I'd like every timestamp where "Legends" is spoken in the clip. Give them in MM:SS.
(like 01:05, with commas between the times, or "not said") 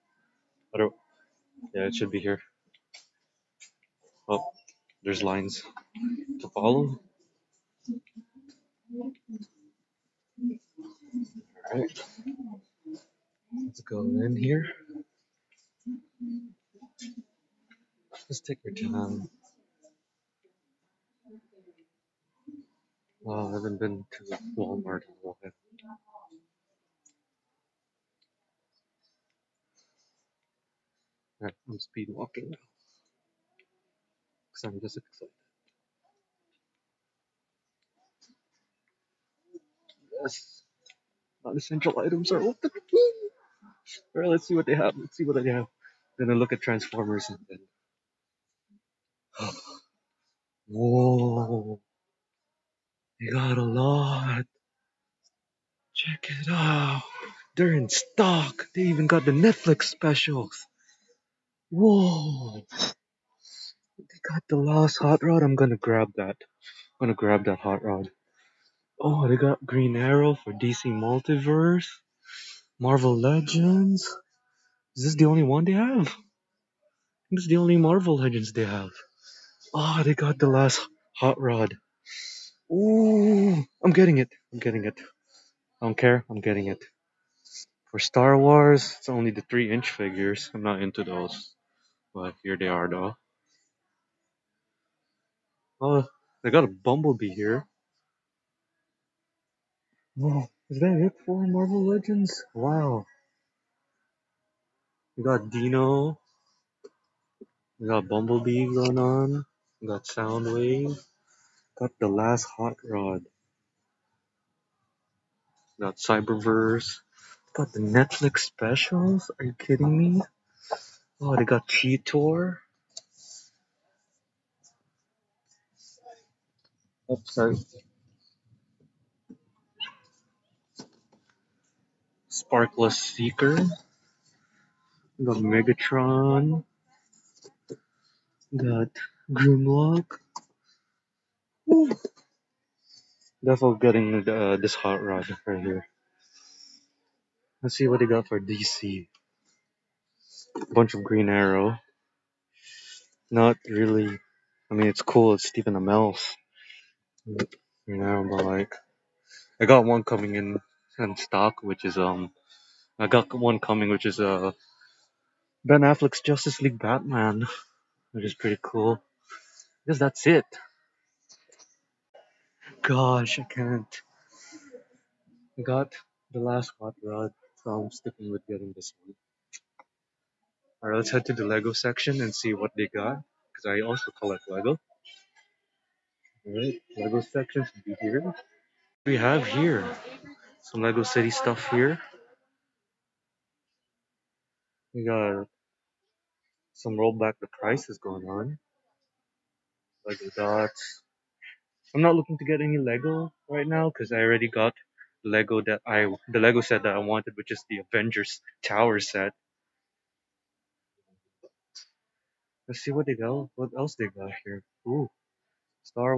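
01:13, 01:18, 01:41.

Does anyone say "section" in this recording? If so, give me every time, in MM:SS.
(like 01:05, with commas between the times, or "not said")
03:01, 03:07.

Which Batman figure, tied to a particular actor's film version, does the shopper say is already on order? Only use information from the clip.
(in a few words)
Ben Affleck's Justice League Batman.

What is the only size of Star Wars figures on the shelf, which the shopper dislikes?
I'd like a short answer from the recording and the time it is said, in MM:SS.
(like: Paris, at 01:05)
3 inch, at 01:29.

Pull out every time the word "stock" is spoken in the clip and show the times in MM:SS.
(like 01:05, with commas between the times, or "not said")
00:57, 02:41.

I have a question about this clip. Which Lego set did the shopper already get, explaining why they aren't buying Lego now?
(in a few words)
Avengers Tower.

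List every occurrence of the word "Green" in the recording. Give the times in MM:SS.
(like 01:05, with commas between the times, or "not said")
01:09, 02:31.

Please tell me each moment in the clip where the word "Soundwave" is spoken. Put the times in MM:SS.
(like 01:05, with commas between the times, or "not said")
01:50.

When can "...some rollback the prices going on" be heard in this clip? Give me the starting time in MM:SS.
03:16.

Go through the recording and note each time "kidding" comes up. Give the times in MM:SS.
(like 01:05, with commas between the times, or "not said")
01:59.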